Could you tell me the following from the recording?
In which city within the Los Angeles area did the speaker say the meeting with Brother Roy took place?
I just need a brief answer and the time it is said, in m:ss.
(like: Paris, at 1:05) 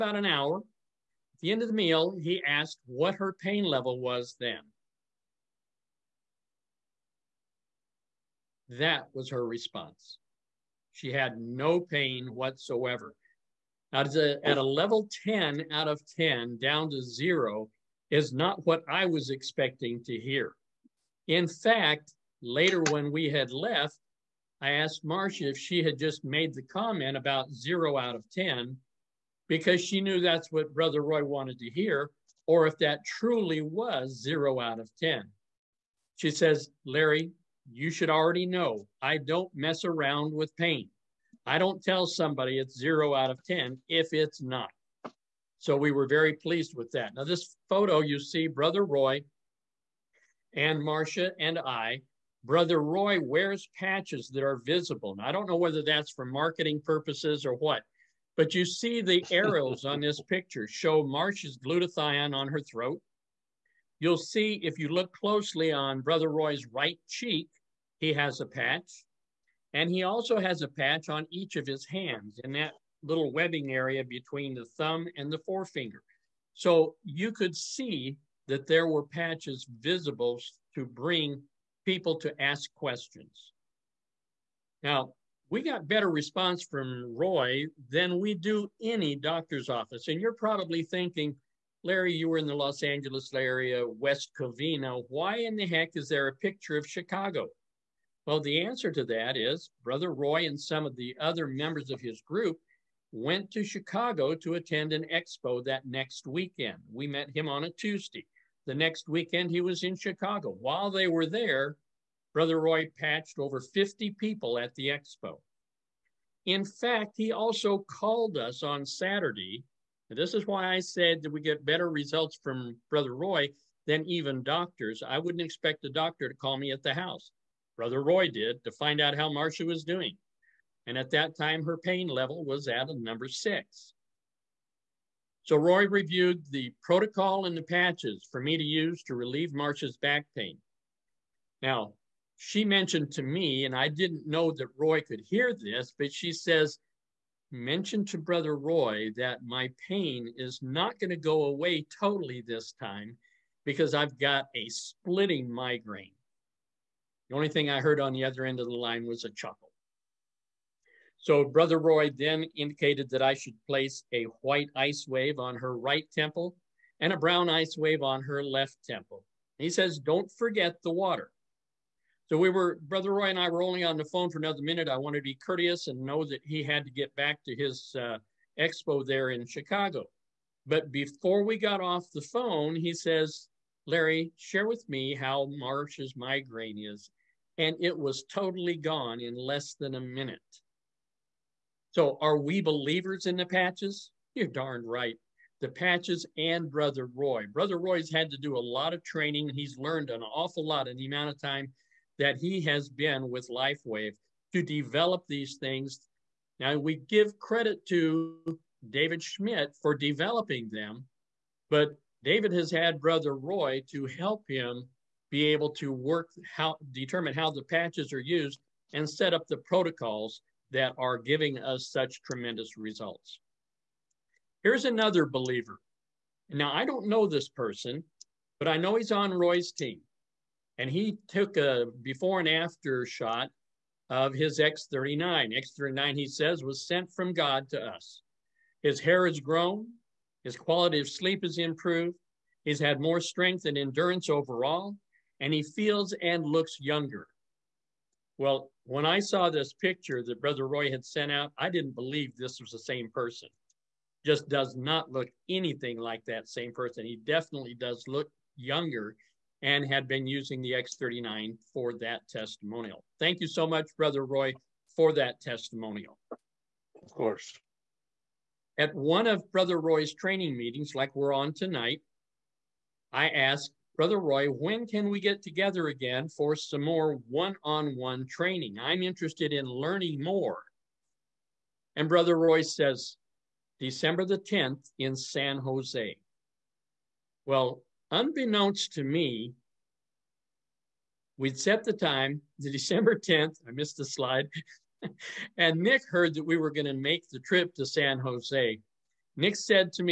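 West Covina, at 1:33.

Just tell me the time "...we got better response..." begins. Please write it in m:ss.
1:25.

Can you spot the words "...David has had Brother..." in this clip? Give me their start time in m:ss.
3:32.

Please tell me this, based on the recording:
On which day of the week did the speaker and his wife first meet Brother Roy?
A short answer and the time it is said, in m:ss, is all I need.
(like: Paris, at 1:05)
Tuesday, at 1:47.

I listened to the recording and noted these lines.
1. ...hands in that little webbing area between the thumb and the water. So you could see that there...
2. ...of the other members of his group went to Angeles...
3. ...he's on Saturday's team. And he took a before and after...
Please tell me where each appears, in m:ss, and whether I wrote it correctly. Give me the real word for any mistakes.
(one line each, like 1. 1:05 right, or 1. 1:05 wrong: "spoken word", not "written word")
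1. 1:11 wrong: "forefinger", not "water"
2. 1:40 wrong: "Chicago", not "Angeles"
3. 3:48 wrong: "Roy", not "Saturday".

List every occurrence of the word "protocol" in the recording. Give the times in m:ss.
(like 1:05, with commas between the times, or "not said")
2:16, 3:39.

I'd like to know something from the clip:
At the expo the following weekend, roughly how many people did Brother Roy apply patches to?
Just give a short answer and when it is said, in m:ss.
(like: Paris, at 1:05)
over 50, at 1:53.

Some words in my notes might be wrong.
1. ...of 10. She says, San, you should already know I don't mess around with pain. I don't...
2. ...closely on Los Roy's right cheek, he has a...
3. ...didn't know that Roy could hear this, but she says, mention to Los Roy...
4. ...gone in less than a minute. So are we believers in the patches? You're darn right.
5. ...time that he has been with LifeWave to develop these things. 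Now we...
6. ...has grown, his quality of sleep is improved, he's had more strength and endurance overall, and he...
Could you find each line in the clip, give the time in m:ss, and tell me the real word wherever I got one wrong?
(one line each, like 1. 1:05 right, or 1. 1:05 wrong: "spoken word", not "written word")
1. 0:34 wrong: "Larry", not "San"
2. 1:05 wrong: "Brother", not "Los"
3. 2:23 wrong: "Brother", not "Los"
4. 3:08 right
5. 3:21 right
6. 3:59 right.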